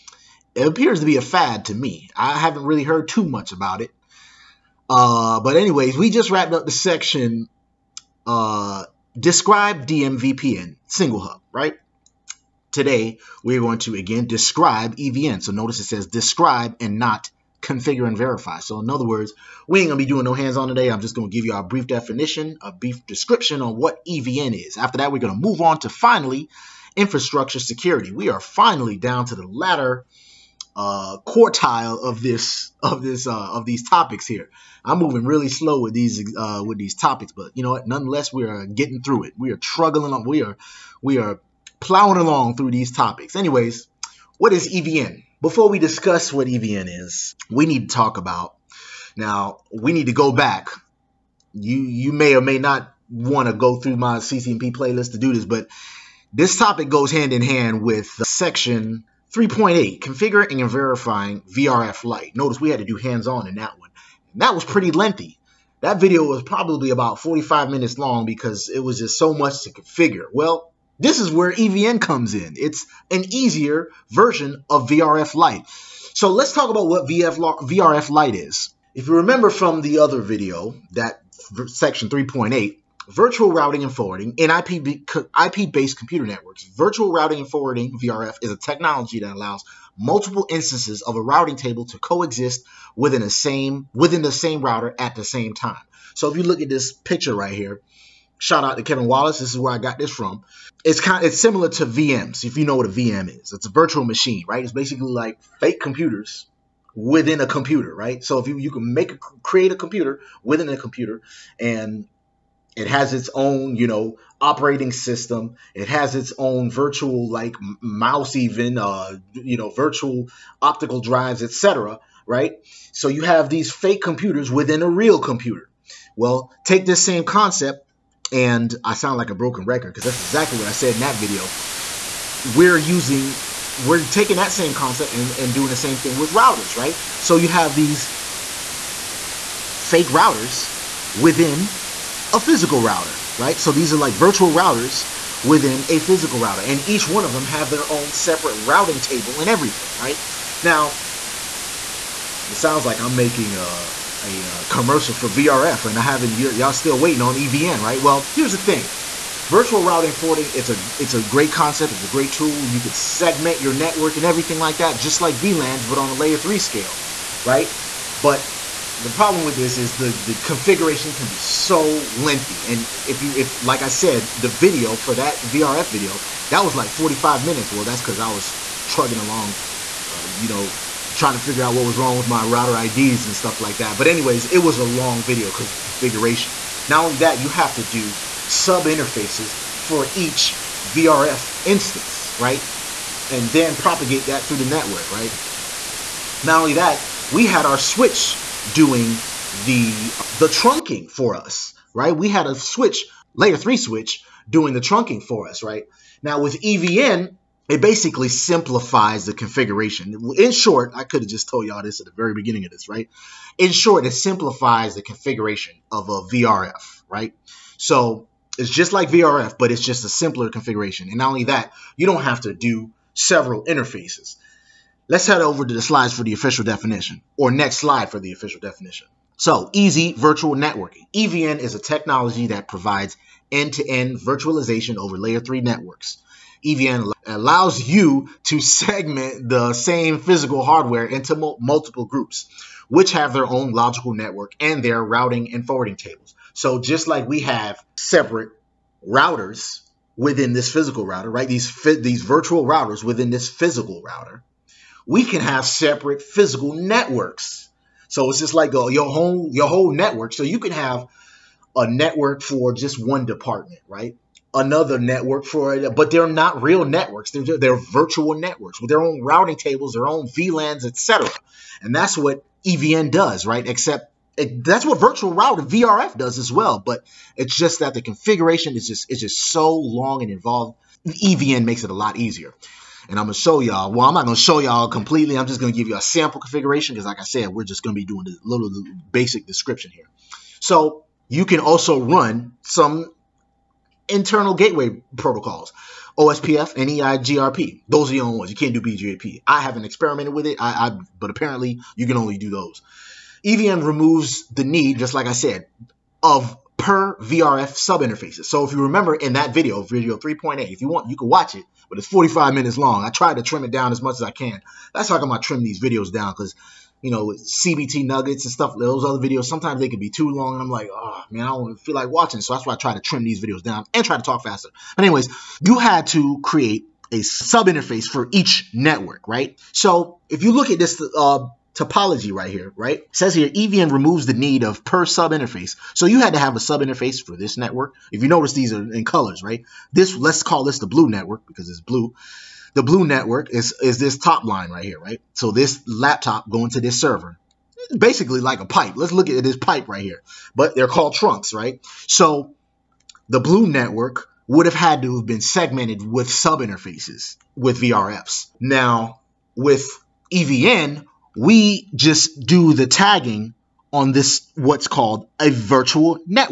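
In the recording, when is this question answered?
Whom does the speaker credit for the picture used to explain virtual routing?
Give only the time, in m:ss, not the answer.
1:38.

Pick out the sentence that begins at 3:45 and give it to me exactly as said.
Let's head over to the slides for the official definition, or next slide for the official definition.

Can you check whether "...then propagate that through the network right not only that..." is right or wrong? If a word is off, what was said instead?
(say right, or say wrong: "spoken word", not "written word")
right.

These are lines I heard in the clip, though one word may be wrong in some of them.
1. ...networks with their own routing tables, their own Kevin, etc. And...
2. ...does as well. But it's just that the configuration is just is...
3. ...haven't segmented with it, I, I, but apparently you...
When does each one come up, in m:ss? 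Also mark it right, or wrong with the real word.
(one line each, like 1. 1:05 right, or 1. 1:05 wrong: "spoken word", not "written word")
1. 4:28 wrong: "VLANs", not "Kevin"
2. 4:36 right
3. 4:59 wrong: "experimented", not "segmented".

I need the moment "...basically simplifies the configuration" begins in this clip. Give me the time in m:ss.
3:27.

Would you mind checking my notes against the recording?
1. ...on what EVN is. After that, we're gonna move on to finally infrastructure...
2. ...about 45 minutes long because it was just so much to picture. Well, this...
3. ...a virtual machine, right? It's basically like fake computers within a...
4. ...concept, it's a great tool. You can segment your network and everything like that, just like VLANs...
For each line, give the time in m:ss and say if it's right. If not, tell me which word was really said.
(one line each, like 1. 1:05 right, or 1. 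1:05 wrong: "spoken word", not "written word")
1. 0:23 right
2. 1:06 wrong: "configure", not "picture"
3. 1:43 right
4. 2:41 right.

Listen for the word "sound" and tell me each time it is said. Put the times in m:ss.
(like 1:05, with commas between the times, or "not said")
2:08, 2:32.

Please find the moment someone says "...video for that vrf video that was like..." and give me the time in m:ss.
2:54.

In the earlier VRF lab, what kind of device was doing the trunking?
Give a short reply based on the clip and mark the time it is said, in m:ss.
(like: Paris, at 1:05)
layer three switch, at 3:23.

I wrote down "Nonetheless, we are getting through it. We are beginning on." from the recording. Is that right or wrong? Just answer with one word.
wrong.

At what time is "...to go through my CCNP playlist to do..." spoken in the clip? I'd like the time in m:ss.
0:53.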